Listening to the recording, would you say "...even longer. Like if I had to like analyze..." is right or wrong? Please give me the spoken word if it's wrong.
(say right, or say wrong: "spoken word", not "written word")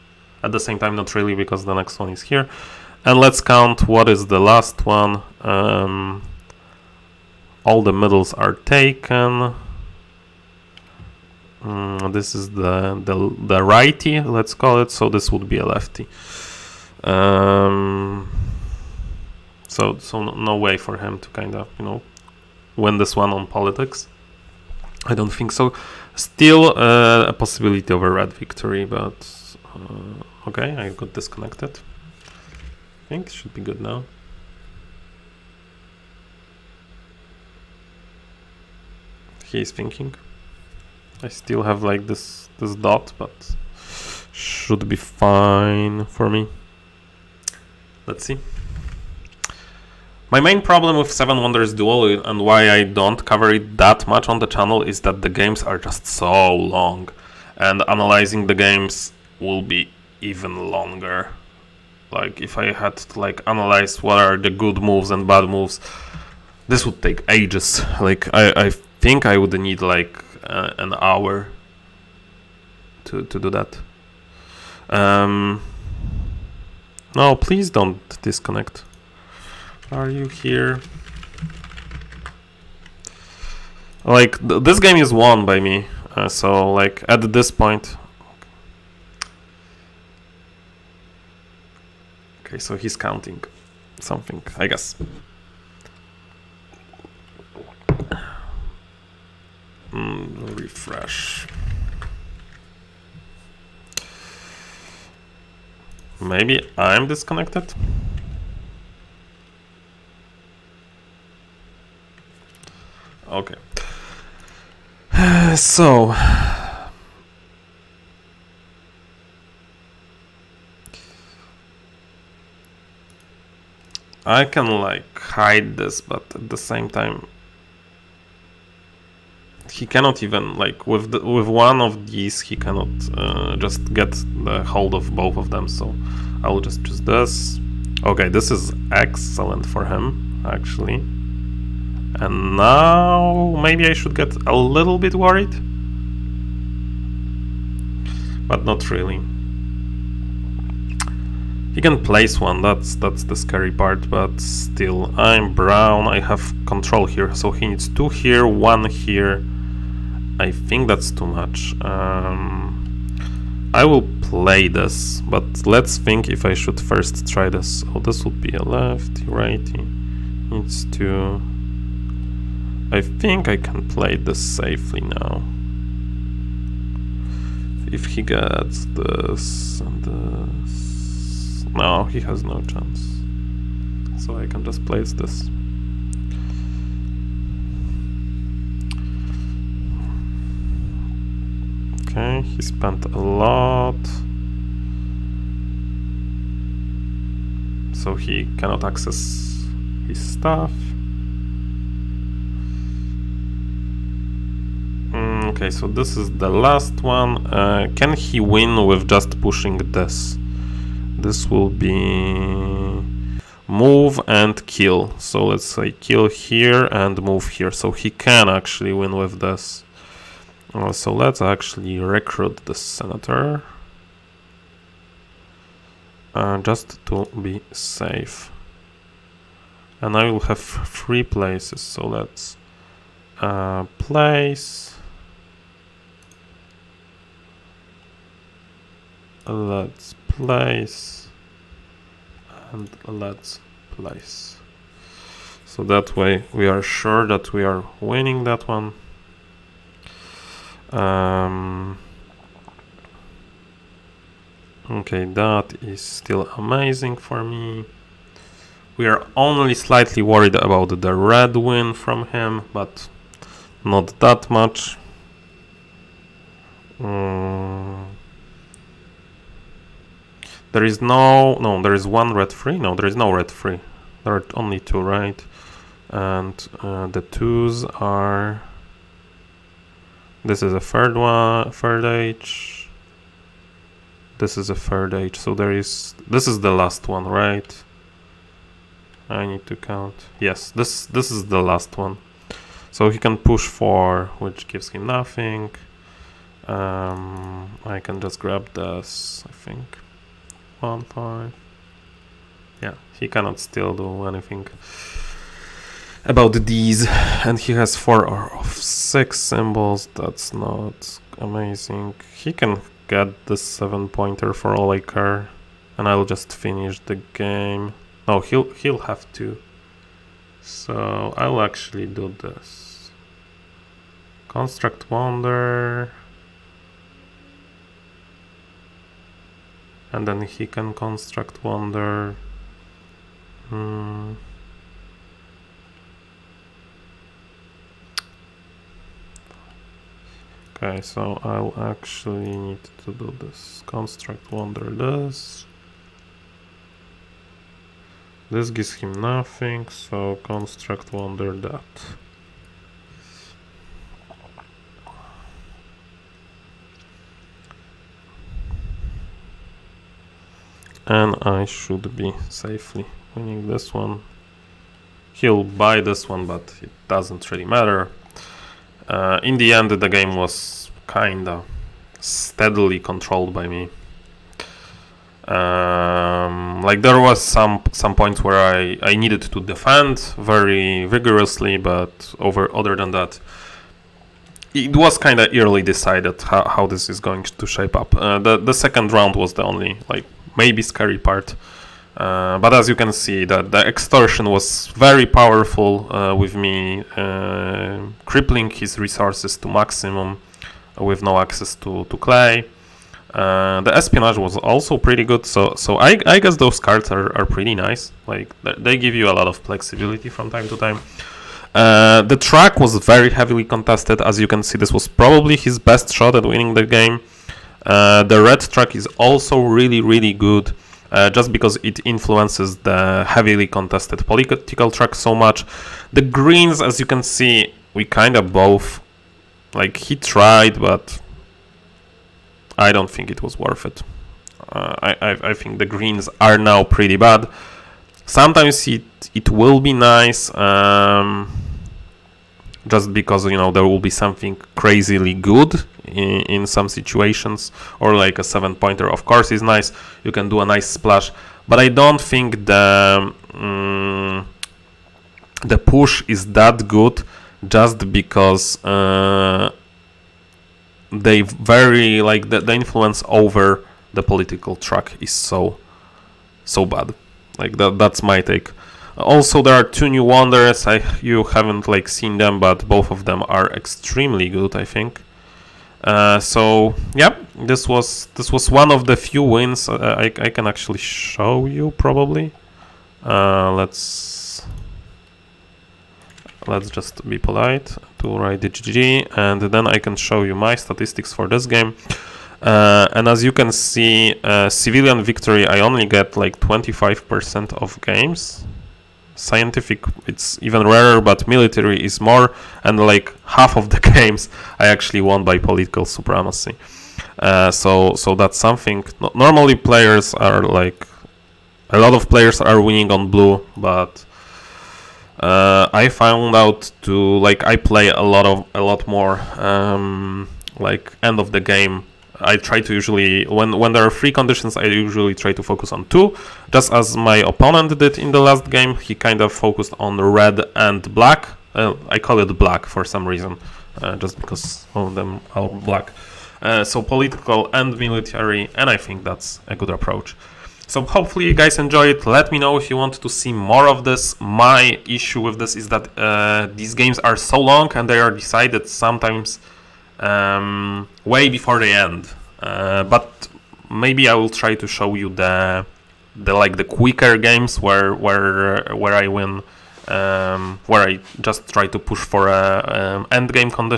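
right.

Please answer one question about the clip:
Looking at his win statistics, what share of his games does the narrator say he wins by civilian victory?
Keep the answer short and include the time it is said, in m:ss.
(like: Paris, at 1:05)
25%, at 8:16.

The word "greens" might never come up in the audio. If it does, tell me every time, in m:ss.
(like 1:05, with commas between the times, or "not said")
7:06, 7:15.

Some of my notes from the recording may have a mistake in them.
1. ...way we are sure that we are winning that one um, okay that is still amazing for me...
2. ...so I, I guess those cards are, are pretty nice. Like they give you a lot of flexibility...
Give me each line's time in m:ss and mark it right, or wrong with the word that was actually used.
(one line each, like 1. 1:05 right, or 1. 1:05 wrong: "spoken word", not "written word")
1. 4:06 right
2. 6:45 right.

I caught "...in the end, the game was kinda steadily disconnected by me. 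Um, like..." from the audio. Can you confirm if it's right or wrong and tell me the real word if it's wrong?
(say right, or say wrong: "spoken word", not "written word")
wrong: "controlled", not "disconnected".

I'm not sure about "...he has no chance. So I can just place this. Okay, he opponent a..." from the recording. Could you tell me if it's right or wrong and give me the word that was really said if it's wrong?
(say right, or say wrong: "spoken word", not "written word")
wrong: "spent", not "opponent".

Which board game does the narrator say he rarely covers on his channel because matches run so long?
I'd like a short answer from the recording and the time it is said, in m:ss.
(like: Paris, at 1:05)
Seven Wonders Duel, at 0:51.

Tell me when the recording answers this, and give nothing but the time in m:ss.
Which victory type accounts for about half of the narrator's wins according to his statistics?
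8:25.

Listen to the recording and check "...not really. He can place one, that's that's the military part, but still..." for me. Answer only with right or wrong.
wrong.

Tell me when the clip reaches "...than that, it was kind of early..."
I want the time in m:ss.
6:22.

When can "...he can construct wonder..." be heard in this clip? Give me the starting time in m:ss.
5:30.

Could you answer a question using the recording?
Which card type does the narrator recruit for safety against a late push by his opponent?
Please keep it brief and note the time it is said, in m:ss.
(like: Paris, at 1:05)
senator, at 3:42.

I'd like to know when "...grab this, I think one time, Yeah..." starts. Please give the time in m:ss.
4:58.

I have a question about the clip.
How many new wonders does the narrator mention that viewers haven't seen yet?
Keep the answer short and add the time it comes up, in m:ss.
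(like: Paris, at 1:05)
2, at 7:49.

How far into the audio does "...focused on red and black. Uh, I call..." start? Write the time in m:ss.
8:49.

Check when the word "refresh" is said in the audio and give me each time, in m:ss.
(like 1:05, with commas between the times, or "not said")
1:40.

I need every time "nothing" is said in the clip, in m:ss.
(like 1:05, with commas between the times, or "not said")
4:55, 5:49.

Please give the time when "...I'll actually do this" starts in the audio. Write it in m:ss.
5:21.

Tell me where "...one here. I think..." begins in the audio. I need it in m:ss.
2:38.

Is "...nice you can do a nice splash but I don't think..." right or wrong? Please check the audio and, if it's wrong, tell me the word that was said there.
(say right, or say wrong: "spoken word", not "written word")
right.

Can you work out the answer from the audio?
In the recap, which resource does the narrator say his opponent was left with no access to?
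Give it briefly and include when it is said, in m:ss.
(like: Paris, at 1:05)
clay, at 6:42.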